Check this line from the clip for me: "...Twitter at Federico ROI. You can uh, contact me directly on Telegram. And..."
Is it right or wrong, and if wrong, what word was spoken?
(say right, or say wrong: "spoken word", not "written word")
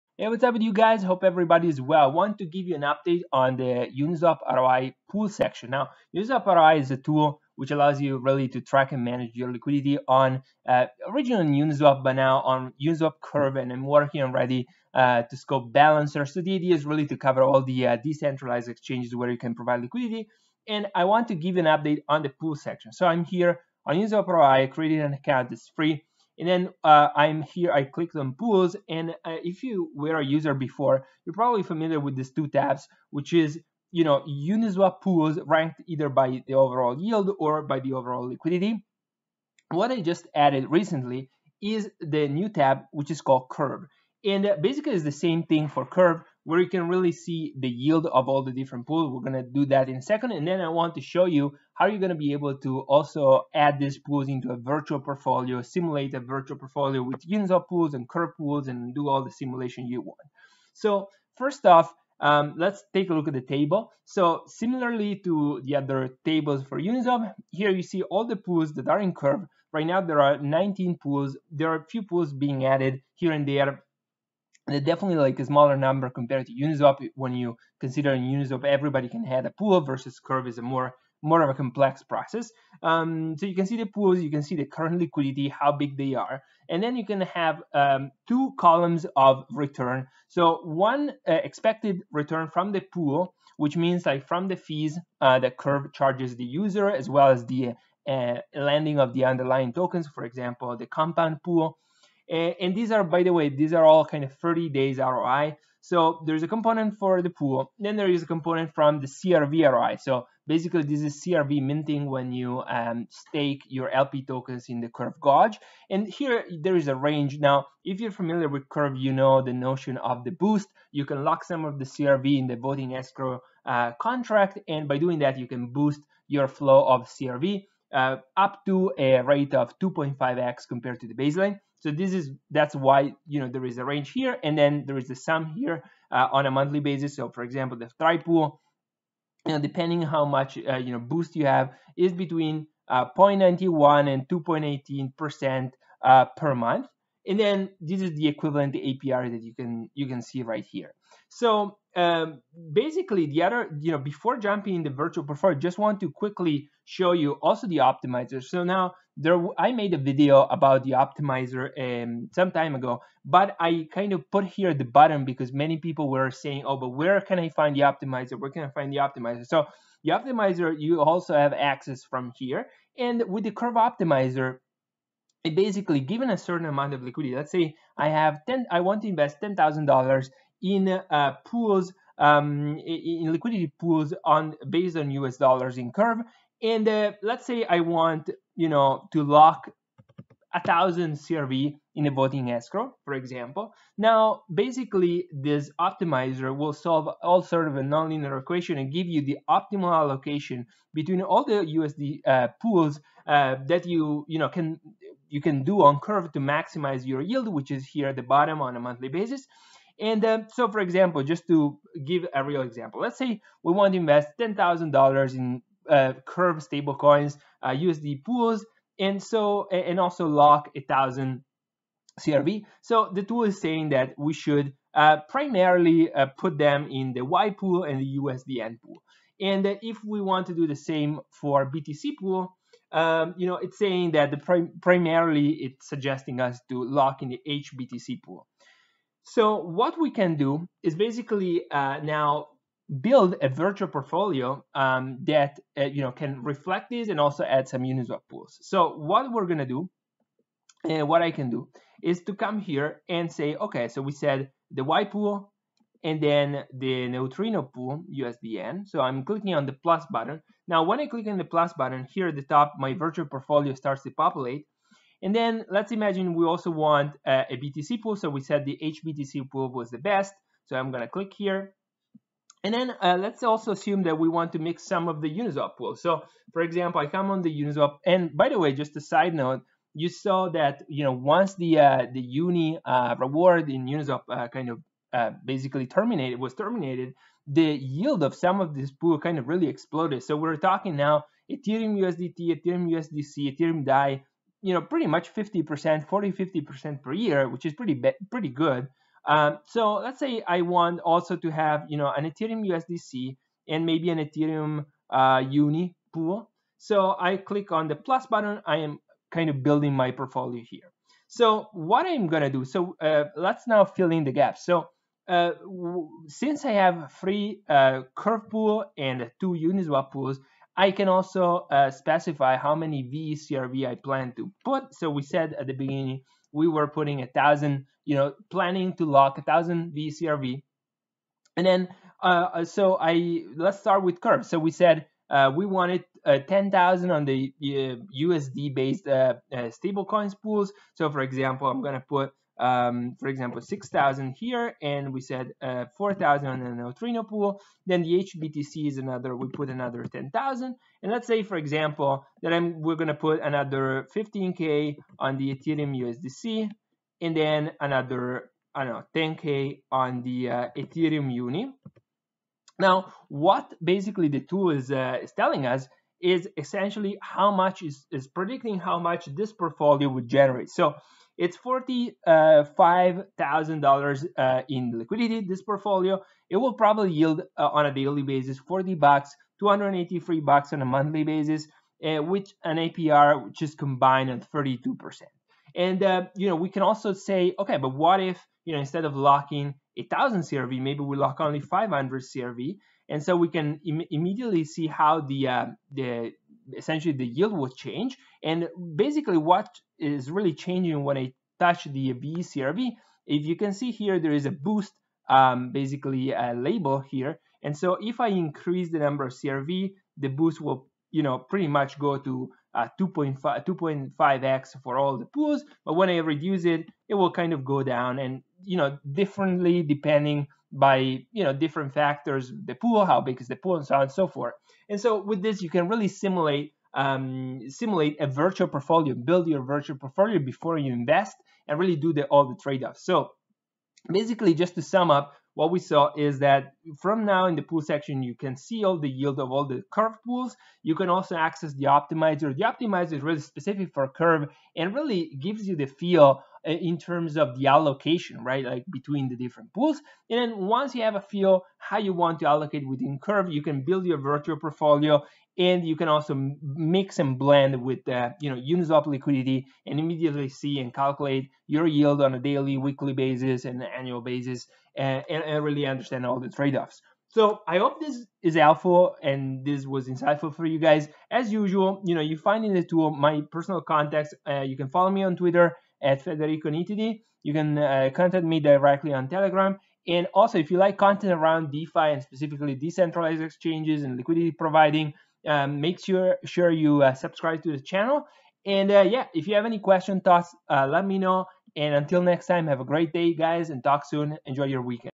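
wrong: "Nitidi", not "ROI".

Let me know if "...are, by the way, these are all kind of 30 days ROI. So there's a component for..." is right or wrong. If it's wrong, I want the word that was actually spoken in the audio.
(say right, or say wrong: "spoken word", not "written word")
right.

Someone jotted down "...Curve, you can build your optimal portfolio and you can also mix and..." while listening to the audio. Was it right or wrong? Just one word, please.
wrong.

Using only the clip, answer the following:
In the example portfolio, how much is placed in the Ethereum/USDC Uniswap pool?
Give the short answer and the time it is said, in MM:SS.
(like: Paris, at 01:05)
15K, at 05:54.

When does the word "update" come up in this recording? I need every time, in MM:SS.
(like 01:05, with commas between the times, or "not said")
00:02, 00:21.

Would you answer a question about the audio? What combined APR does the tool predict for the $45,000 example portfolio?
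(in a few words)
32%.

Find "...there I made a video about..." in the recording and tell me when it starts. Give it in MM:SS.
02:39.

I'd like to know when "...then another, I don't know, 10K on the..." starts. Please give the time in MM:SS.
05:57.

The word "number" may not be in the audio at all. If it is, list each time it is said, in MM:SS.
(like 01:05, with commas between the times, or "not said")
01:15, 06:48.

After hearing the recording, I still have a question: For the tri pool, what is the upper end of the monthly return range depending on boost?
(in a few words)
2.18 percent.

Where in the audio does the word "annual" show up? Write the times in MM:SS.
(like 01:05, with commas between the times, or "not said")
07:43.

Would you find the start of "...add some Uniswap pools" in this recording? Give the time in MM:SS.
04:07.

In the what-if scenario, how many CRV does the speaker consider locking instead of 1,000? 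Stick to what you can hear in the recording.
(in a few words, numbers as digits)
500.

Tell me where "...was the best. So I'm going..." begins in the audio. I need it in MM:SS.
04:29.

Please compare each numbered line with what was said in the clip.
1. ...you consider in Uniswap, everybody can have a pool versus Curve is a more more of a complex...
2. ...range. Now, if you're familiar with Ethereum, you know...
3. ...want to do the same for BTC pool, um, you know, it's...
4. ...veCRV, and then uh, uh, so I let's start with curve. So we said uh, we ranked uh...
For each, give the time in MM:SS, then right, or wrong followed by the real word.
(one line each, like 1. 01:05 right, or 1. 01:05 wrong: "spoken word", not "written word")
1. 01:17 right
2. 01:56 wrong: "Curve", not "Ethereum"
3. 03:50 right
4. 05:29 wrong: "wanted", not "ranked".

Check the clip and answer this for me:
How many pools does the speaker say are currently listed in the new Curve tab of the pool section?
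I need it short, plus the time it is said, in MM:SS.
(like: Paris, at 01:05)
19, at 01:10.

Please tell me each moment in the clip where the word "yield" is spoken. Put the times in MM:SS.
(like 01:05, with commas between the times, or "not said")
00:36, 00:47, 03:27, 04:47, 06:17, 06:37, 07:19, 07:41.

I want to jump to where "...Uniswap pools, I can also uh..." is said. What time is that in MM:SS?
05:19.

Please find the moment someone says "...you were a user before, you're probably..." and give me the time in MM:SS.
00:29.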